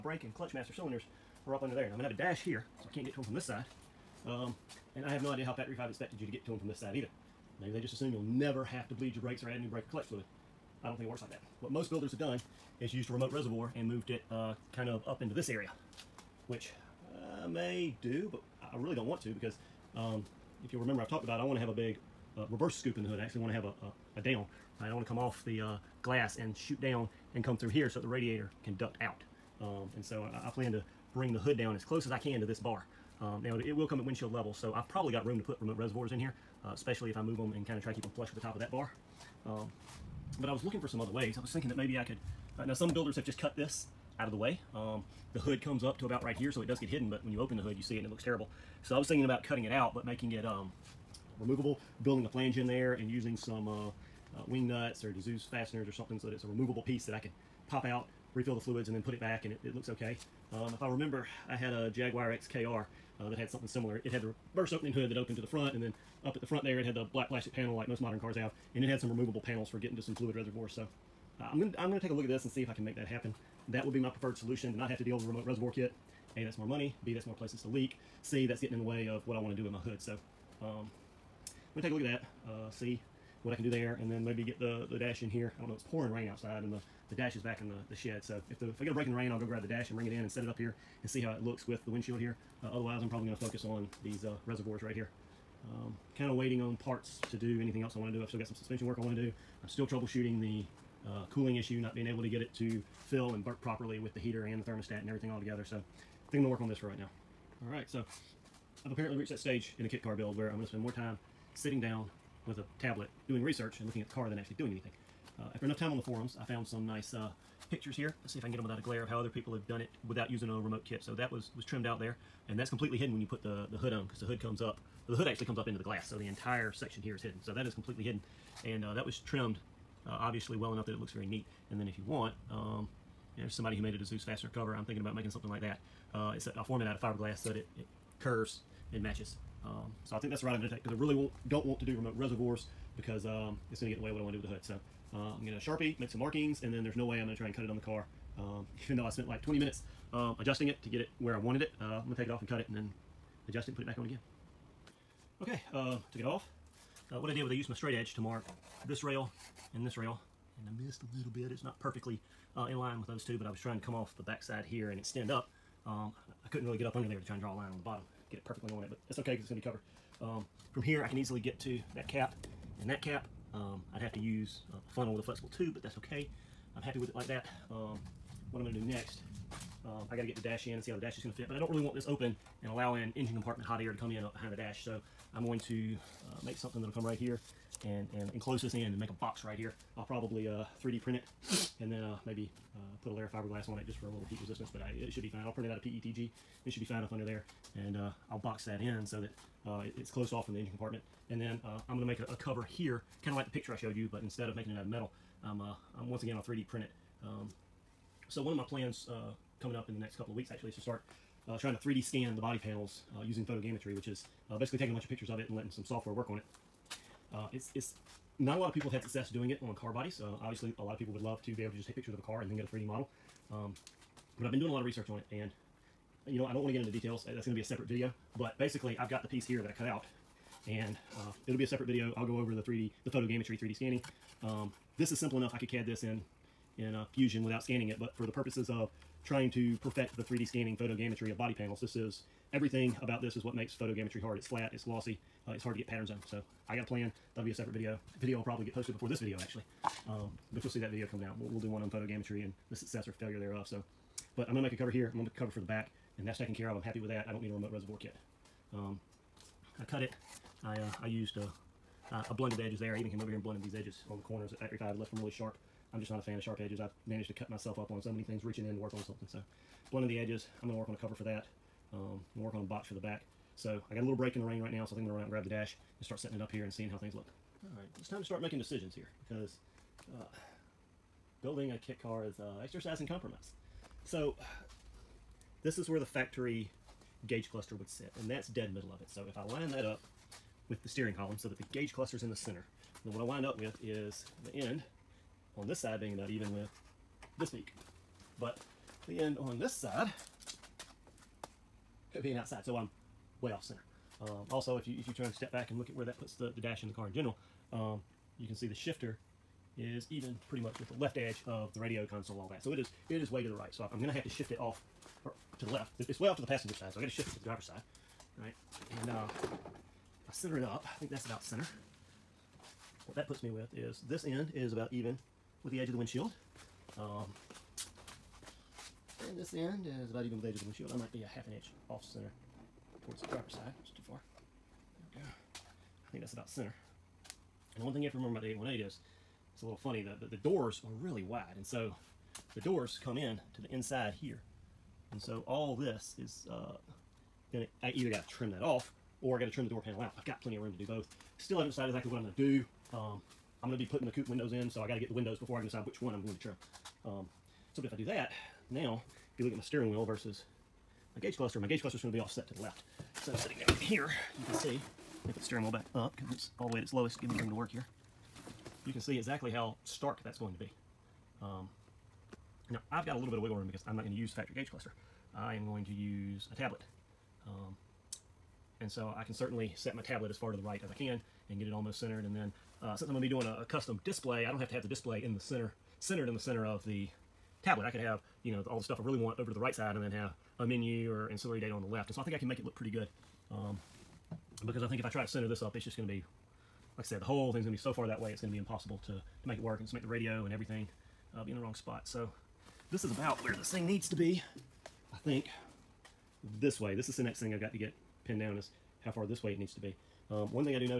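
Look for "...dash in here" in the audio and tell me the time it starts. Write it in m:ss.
1:24.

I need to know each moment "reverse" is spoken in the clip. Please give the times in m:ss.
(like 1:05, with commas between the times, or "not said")
0:22, 1:04.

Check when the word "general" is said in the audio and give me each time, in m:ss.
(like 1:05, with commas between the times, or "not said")
5:07.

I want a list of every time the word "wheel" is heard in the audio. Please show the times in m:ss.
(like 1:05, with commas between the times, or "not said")
5:59, 6:05.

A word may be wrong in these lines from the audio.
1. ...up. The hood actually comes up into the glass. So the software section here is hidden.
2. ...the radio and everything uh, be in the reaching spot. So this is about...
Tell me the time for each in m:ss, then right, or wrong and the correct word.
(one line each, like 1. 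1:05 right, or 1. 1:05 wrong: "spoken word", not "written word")
1. 2:04 wrong: "entire", not "software"
2. 6:40 wrong: "wrong", not "reaching".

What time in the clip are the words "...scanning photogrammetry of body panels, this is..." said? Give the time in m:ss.
4:00.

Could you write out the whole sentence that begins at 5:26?
Um, and this end is about even with the edge of the windshield.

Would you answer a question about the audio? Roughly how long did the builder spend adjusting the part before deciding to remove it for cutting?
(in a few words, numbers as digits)
20 minutes.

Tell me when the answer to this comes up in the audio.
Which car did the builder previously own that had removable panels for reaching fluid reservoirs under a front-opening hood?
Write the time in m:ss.
1:01.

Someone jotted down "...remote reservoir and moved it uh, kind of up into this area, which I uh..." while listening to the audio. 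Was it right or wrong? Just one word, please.
right.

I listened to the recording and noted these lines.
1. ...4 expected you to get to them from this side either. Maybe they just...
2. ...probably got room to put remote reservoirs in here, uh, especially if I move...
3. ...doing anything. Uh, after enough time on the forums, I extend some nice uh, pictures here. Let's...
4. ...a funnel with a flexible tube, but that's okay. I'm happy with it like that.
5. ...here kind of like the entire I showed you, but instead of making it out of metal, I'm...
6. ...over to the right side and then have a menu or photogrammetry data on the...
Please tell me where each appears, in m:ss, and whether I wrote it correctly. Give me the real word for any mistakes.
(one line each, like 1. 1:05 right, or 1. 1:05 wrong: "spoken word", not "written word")
1. 0:05 wrong: "5", not "4"
2. 0:34 right
3. 1:54 wrong: "found", not "extend"
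4. 2:54 right
5. 3:22 wrong: "picture", not "entire"
6. 6:29 wrong: "ancillary", not "photogrammetry".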